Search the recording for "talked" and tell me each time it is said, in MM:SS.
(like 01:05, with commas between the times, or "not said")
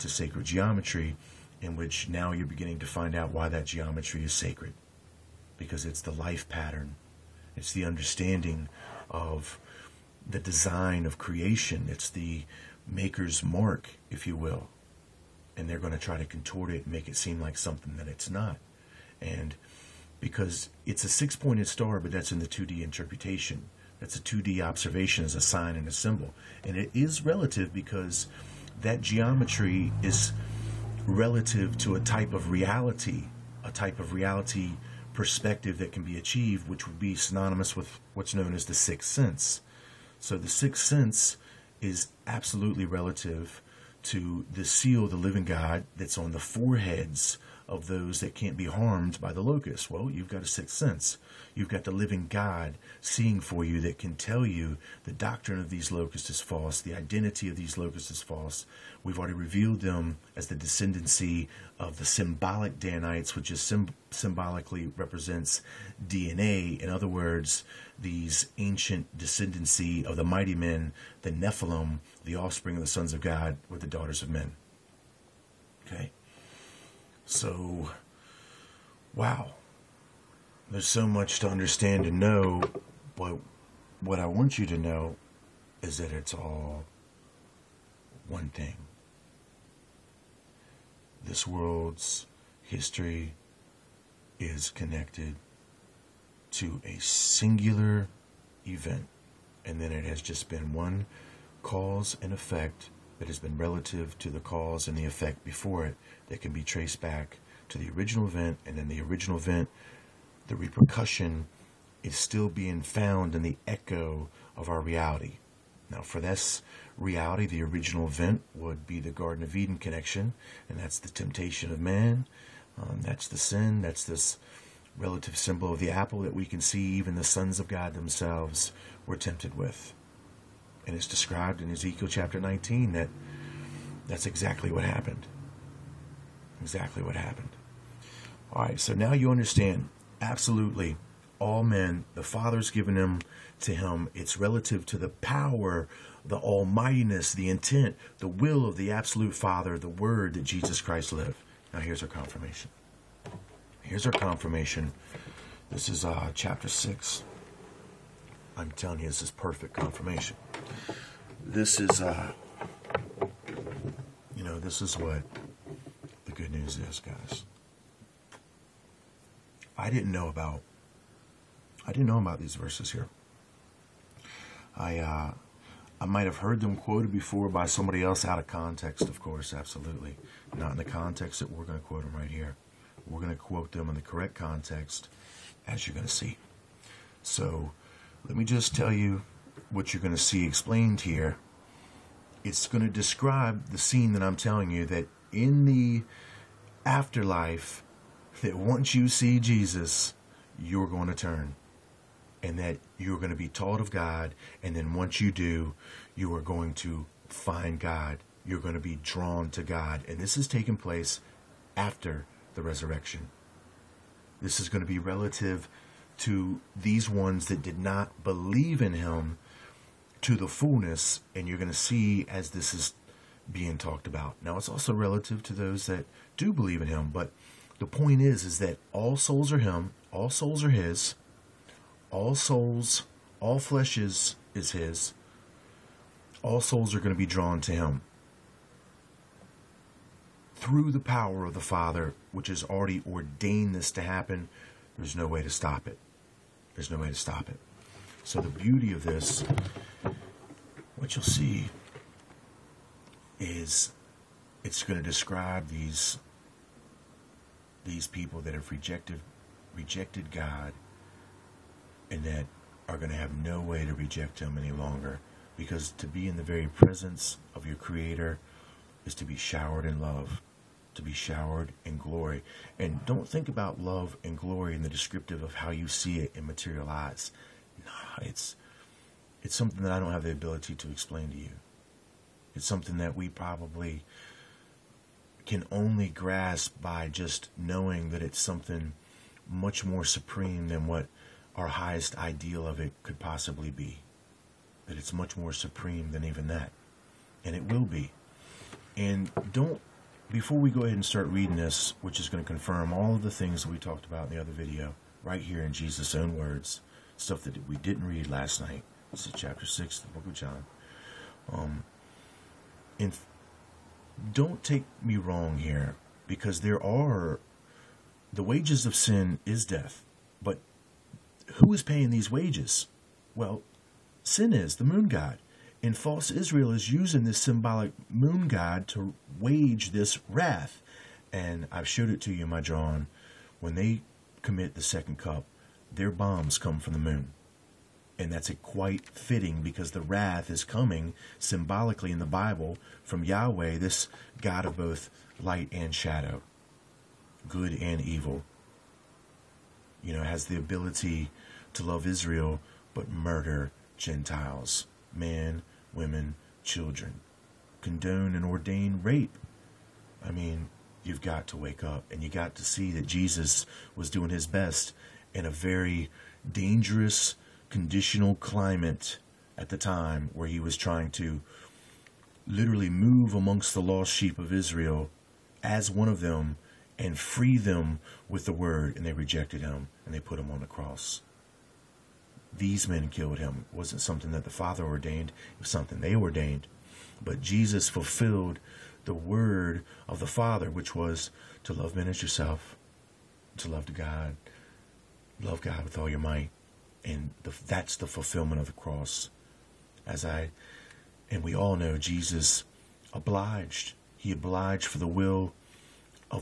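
03:43, 05:03.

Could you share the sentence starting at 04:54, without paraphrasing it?
That it's much more supreme than even that.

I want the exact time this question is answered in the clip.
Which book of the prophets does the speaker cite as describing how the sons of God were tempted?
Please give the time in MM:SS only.
02:11.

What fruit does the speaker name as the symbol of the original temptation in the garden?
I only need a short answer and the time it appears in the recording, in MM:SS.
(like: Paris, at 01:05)
apple, at 02:05.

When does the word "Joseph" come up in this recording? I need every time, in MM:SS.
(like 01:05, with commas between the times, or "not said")
not said.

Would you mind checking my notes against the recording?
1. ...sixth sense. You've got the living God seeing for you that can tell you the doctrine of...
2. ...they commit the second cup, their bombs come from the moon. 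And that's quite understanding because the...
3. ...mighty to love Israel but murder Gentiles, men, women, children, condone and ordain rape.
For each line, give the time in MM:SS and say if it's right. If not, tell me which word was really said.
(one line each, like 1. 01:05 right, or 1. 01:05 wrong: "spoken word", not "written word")
1. 00:50 right
2. 05:33 wrong: "fitting", not "understanding"
3. 05:50 wrong: "ability", not "mighty".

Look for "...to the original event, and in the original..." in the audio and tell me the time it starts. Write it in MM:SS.
01:47.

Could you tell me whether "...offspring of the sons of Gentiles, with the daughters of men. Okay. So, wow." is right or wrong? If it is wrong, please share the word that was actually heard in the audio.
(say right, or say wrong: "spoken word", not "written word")
wrong: "God", not "Gentiles".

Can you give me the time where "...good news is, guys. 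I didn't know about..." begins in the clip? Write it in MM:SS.
02:46.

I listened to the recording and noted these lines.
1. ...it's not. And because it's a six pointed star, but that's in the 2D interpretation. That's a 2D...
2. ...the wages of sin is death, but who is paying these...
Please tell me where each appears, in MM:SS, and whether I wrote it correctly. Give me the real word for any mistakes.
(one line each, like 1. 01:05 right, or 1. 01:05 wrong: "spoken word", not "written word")
1. 00:18 right
2. 05:18 right.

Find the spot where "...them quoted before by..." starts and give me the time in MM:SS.
02:56.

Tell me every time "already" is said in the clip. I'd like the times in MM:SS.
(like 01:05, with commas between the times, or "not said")
00:59, 04:02.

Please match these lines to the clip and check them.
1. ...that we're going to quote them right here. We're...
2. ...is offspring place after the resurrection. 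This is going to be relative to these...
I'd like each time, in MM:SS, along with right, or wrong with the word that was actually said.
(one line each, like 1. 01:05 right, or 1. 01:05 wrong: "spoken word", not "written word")
1. 03:01 right
2. 03:30 wrong: "taking", not "offspring".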